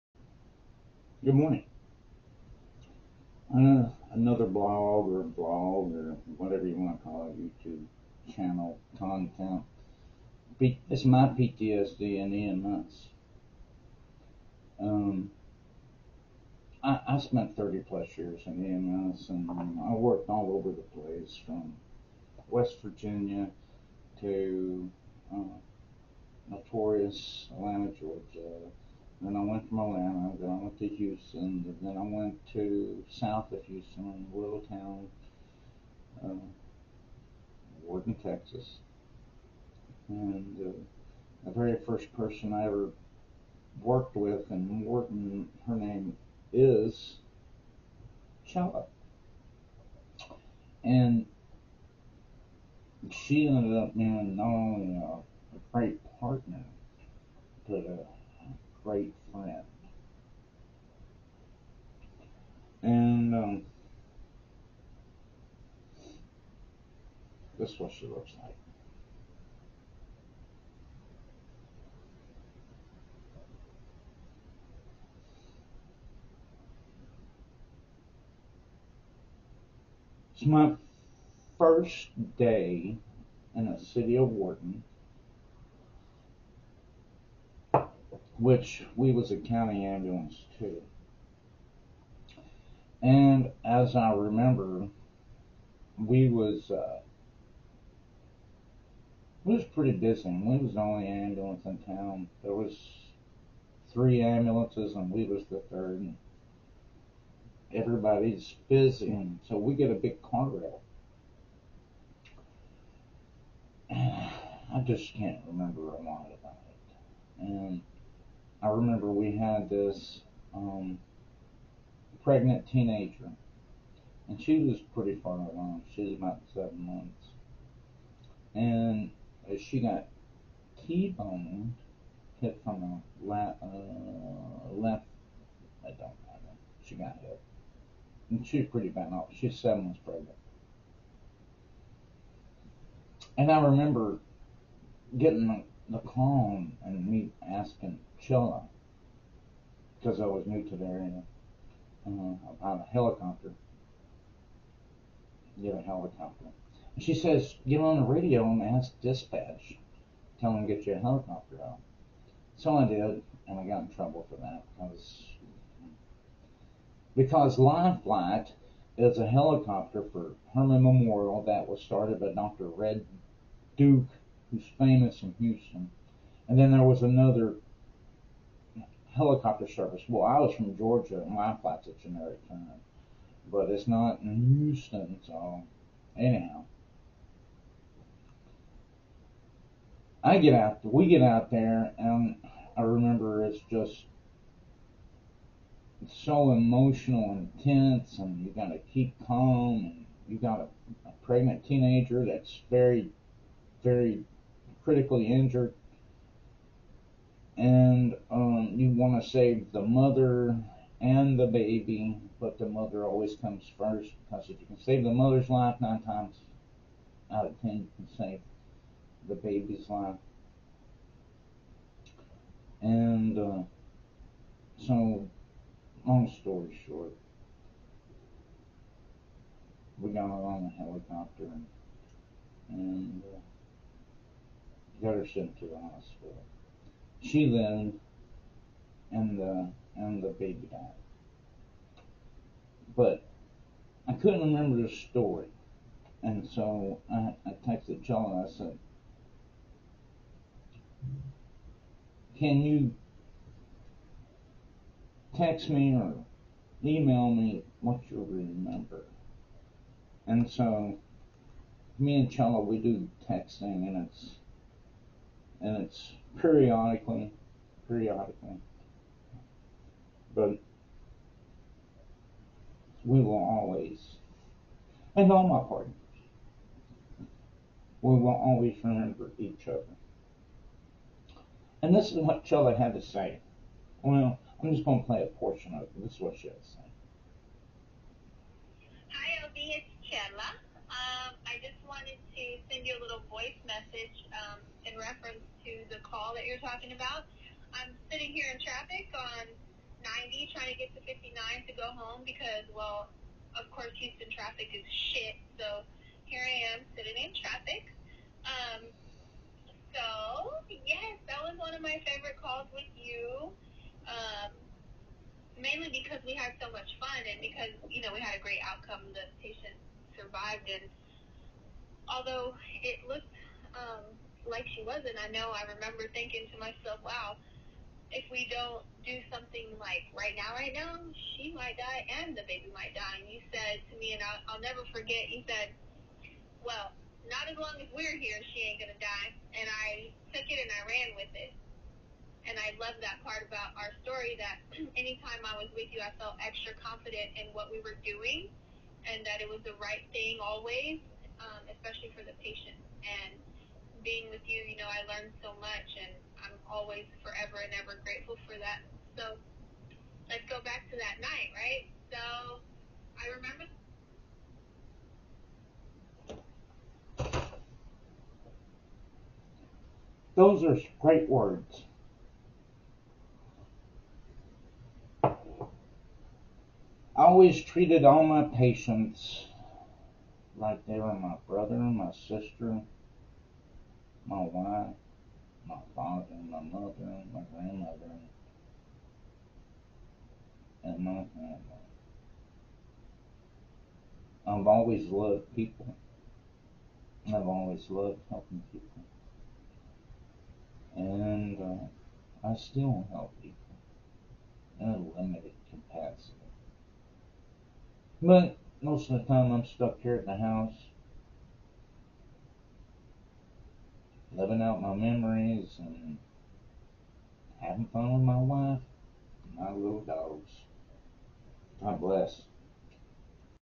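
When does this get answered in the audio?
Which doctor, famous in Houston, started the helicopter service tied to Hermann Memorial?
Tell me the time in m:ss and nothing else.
2:52.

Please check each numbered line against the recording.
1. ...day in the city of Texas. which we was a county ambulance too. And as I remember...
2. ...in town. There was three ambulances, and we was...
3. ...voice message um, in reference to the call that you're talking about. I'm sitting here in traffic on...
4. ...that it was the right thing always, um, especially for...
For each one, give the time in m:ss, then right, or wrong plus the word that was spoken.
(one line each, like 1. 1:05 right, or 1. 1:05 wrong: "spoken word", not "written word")
1. 1:22 wrong: "Wharton", not "Texas"
2. 1:41 right
3. 4:53 right
4. 5:49 right.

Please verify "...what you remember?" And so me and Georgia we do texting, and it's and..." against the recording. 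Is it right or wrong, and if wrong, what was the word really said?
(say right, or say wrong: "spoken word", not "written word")
wrong: "Chella", not "Georgia".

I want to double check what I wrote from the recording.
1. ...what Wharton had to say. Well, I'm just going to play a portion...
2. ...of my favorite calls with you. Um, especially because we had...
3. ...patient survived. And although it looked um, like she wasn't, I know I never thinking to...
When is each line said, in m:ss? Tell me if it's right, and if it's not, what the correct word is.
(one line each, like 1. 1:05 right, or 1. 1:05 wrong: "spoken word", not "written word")
1. 4:42 wrong: "Chella", not "Wharton"
2. 5:11 wrong: "mainly", not "especially"
3. 5:19 wrong: "remember", not "never".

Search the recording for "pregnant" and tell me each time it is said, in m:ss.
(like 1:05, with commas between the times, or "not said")
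2:02, 2:20, 3:21.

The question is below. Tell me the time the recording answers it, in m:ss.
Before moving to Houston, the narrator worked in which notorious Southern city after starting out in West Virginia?
0:27.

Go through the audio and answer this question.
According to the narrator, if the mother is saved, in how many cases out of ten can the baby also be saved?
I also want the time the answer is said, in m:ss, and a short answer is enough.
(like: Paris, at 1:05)
9, at 3:35.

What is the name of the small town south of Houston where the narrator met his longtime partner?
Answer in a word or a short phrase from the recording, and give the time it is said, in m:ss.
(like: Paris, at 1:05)
Wharton, Texas, at 0:37.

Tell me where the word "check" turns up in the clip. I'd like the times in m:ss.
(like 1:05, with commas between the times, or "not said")
not said.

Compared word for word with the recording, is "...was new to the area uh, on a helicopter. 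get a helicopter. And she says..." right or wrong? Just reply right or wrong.
right.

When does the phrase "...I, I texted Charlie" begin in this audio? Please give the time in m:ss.
4:07.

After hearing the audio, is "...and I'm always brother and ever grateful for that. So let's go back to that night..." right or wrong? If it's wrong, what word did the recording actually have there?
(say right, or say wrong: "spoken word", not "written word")
wrong: "forever", not "brother".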